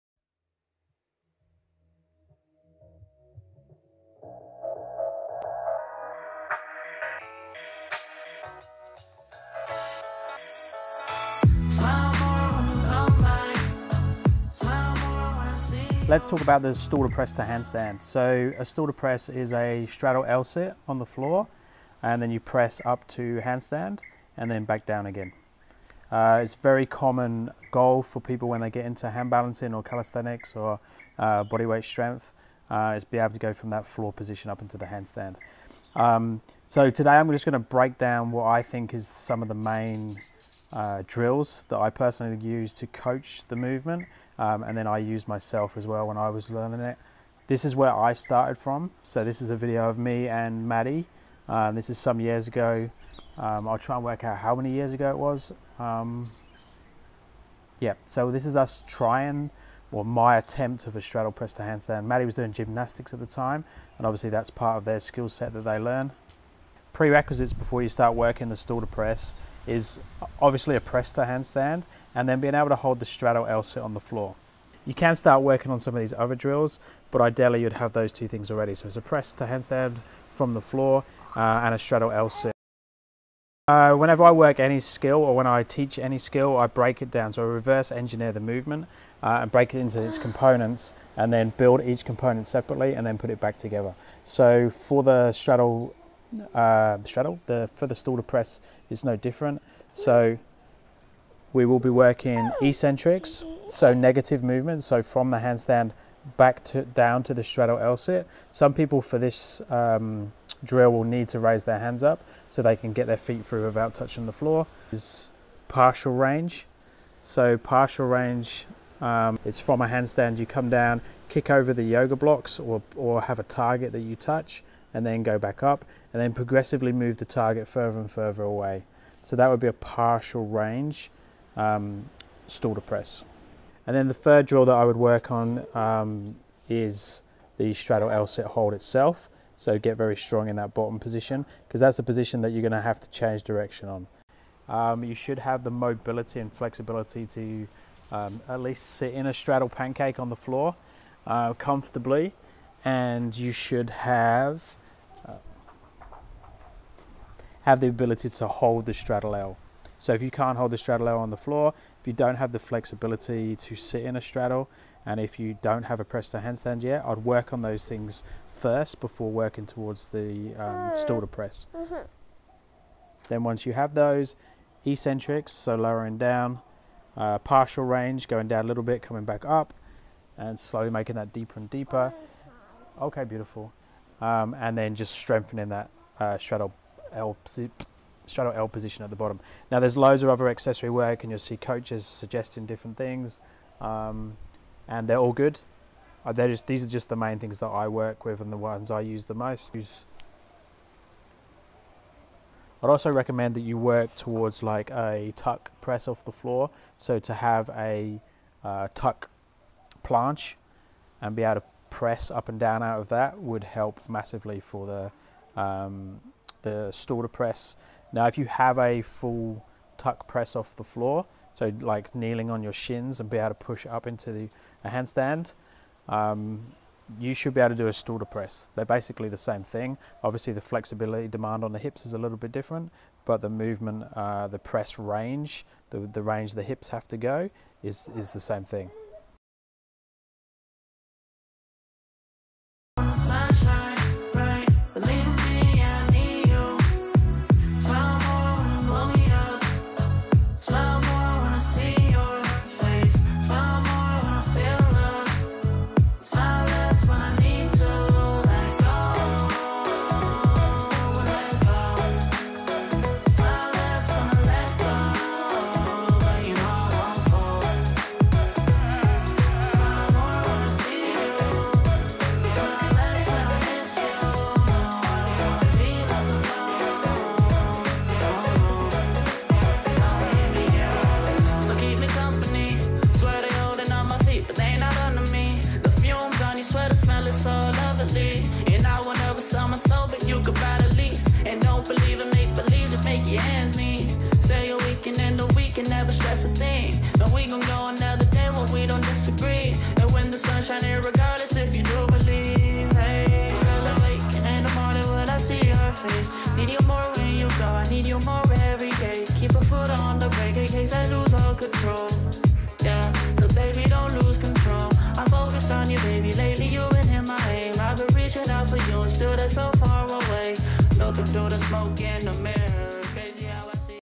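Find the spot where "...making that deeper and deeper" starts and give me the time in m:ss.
3:00.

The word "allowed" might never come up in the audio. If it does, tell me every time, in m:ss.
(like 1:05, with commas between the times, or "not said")
not said.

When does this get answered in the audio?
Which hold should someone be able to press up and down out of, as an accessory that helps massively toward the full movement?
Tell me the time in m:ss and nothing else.
3:28.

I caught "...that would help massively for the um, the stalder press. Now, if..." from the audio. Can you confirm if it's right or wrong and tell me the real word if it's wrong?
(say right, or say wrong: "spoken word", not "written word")
right.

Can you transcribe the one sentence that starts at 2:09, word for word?
So that would be a partial range um, stalder press.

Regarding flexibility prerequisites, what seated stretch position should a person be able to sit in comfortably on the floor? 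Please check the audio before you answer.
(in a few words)
straddle pancake.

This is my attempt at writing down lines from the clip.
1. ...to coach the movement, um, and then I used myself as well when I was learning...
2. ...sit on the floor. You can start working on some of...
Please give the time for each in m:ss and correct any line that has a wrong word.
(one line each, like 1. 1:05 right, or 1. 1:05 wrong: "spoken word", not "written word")
1. 0:42 right
2. 1:13 right.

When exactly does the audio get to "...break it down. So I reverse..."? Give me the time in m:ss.
1:26.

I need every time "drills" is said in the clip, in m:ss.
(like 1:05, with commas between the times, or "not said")
0:41, 1:16, 1:50, 2:14.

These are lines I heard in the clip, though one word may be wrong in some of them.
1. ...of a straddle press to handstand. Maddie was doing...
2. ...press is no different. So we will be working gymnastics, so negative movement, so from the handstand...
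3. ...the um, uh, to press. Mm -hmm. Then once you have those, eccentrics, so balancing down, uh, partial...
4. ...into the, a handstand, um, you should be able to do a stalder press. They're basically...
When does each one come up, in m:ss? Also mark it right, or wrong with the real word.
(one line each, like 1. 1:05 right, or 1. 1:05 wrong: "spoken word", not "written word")
1. 1:00 right
2. 1:38 wrong: "eccentrics", not "gymnastics"
3. 2:50 wrong: "lowering", not "balancing"
4. 3:44 right.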